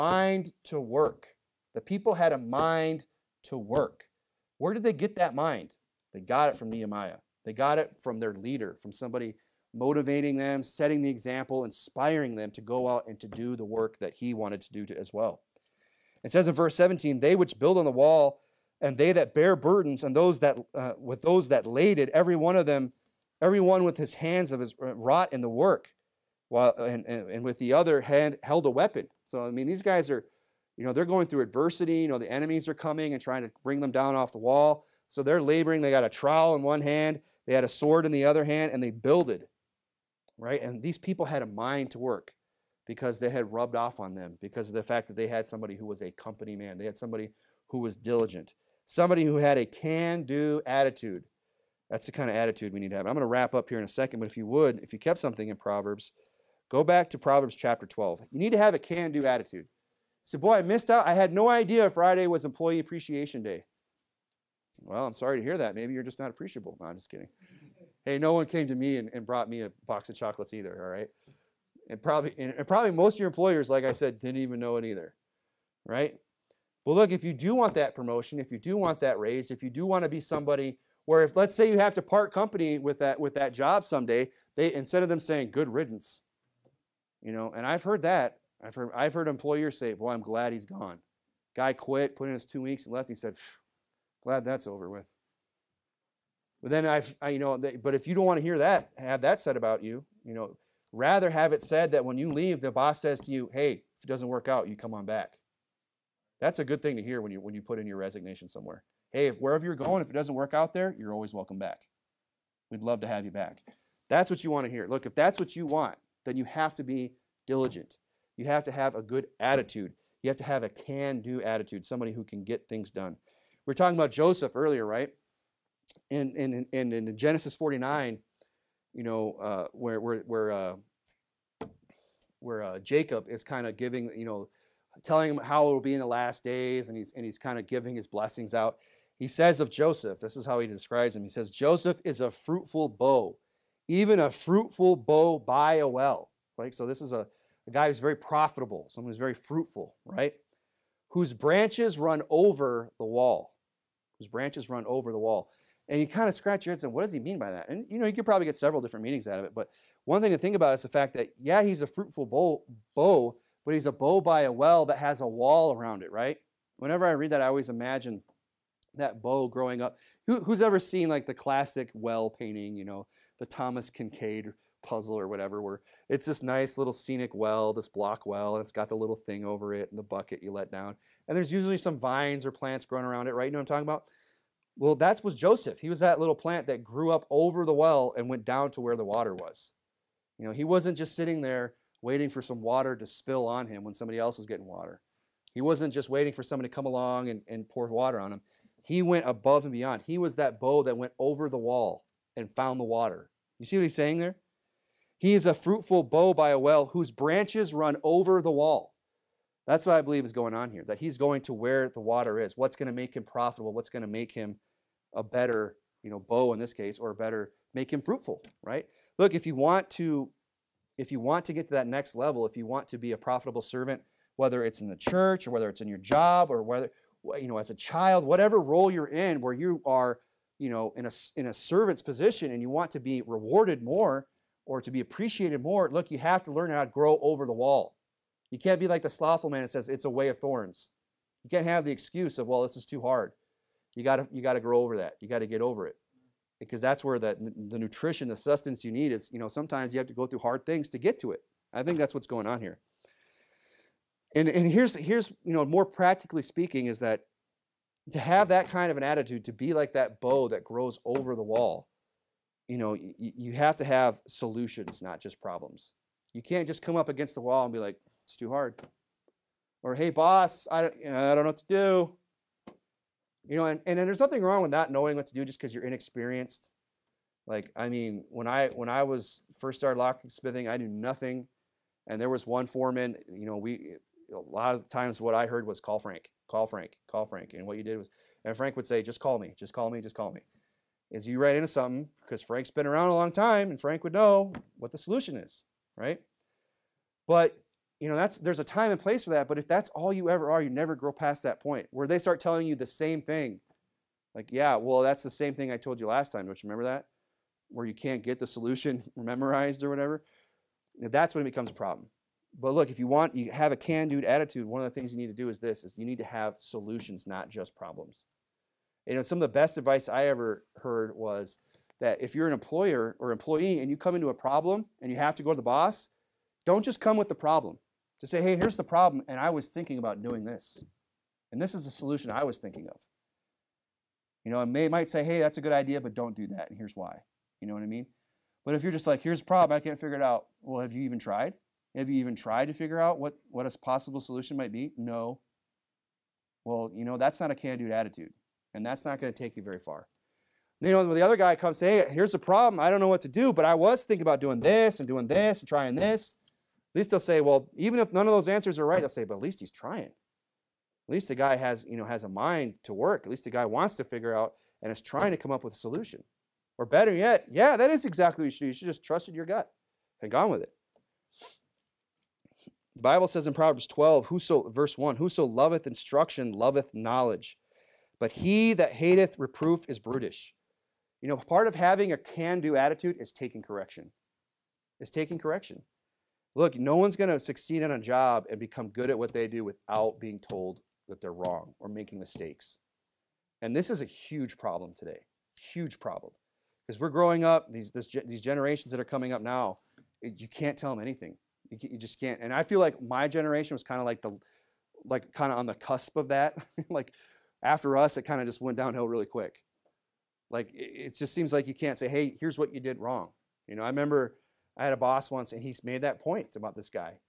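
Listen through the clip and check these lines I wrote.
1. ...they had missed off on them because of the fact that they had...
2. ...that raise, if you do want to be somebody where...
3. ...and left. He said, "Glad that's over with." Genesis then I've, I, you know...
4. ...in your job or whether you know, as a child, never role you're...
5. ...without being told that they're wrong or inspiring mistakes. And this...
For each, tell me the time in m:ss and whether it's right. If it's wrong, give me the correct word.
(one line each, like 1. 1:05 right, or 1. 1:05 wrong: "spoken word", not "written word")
1. 0:43 wrong: "rubbed", not "missed"
2. 1:19 right
3. 1:32 wrong: "But", not "Genesis"
4. 3:45 wrong: "whatever", not "never"
5. 6:29 wrong: "making", not "inspiring".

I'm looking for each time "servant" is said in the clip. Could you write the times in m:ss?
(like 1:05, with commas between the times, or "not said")
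3:43, 3:51.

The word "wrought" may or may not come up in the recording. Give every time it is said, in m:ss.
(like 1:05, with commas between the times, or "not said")
0:24.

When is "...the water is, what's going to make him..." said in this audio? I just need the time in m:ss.
3:31.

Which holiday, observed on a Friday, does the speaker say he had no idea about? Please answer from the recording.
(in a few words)
Employee Appreciation Day.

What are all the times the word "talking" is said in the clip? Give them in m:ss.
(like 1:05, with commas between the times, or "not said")
2:03, 3:03.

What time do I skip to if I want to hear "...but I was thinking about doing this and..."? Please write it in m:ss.
5:53.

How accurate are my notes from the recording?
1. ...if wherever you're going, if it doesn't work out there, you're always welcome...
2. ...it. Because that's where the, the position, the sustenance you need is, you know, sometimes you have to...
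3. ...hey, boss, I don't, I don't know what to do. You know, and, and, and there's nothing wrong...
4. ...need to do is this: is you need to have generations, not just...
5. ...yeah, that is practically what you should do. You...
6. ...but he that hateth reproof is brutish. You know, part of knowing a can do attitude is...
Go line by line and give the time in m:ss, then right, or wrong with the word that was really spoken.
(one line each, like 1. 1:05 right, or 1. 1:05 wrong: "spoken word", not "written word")
1. 1:49 right
2. 4:05 wrong: "nutrition", not "position"
3. 4:29 right
4. 5:15 wrong: "solutions", not "generations"
5. 6:07 wrong: "exactly", not "practically"
6. 6:18 wrong: "having", not "knowing".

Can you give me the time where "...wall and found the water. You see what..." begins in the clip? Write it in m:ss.
3:21.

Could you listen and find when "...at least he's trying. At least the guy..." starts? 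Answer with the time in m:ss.
5:59.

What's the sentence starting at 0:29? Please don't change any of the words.
So I mean, these guys are, you know, they're going through adversity.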